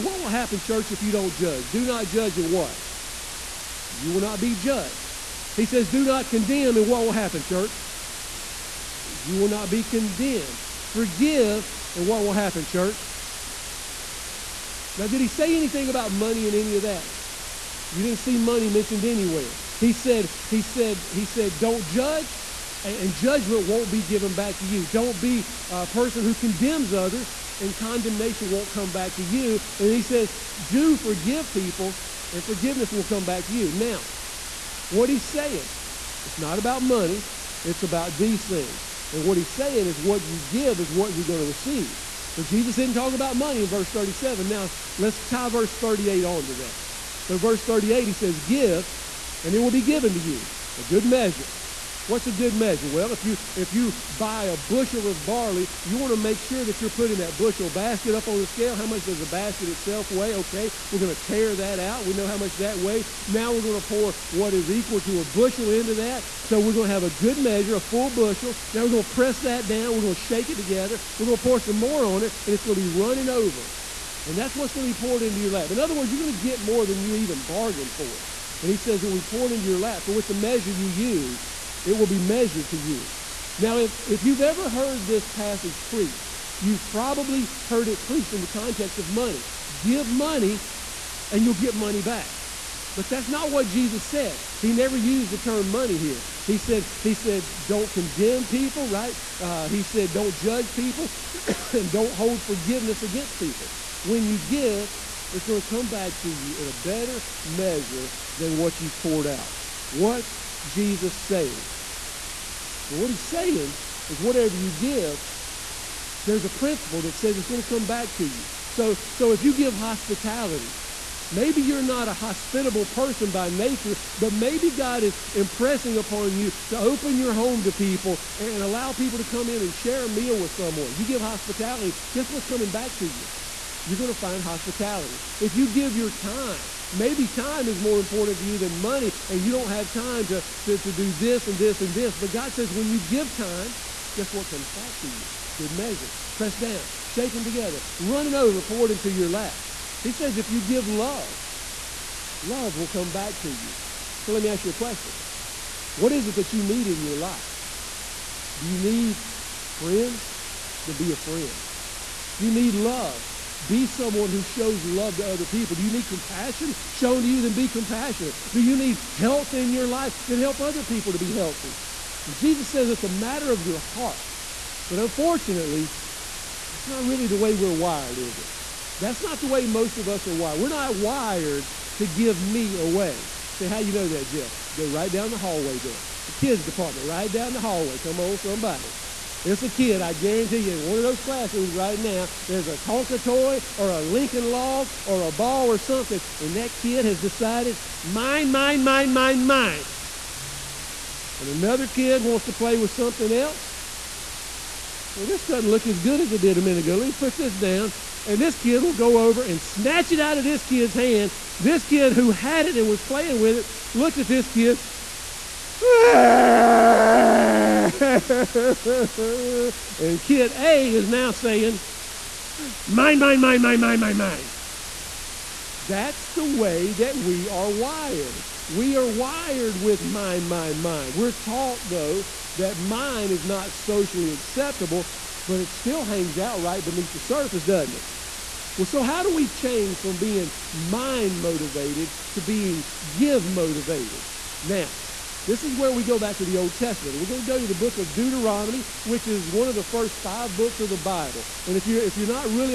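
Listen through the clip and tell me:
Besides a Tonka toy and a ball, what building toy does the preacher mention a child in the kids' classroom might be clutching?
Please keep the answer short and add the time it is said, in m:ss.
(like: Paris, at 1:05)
Lincoln log, at 3:14.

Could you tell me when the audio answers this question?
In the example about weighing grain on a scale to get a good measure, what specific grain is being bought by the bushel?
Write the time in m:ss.
0:55.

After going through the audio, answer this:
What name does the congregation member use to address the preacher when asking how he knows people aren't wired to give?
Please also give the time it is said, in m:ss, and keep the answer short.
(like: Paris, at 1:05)
Jeff, at 3:04.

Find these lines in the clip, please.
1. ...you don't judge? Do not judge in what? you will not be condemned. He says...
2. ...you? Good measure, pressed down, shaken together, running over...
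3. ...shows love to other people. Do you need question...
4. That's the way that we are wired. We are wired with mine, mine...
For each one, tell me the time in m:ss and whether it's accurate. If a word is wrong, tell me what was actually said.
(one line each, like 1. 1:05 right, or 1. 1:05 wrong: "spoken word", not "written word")
1. 0:01 wrong: "judged", not "condemned"
2. 2:25 right
3. 2:44 wrong: "compassion", not "question"
4. 3:45 right.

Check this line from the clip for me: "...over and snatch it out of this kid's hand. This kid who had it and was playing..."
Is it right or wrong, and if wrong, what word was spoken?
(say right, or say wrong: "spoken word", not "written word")
right.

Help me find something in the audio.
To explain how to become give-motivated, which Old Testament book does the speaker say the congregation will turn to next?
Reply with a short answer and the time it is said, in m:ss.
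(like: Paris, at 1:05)
Deuteronomy, at 4:08.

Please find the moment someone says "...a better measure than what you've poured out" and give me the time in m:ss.
1:46.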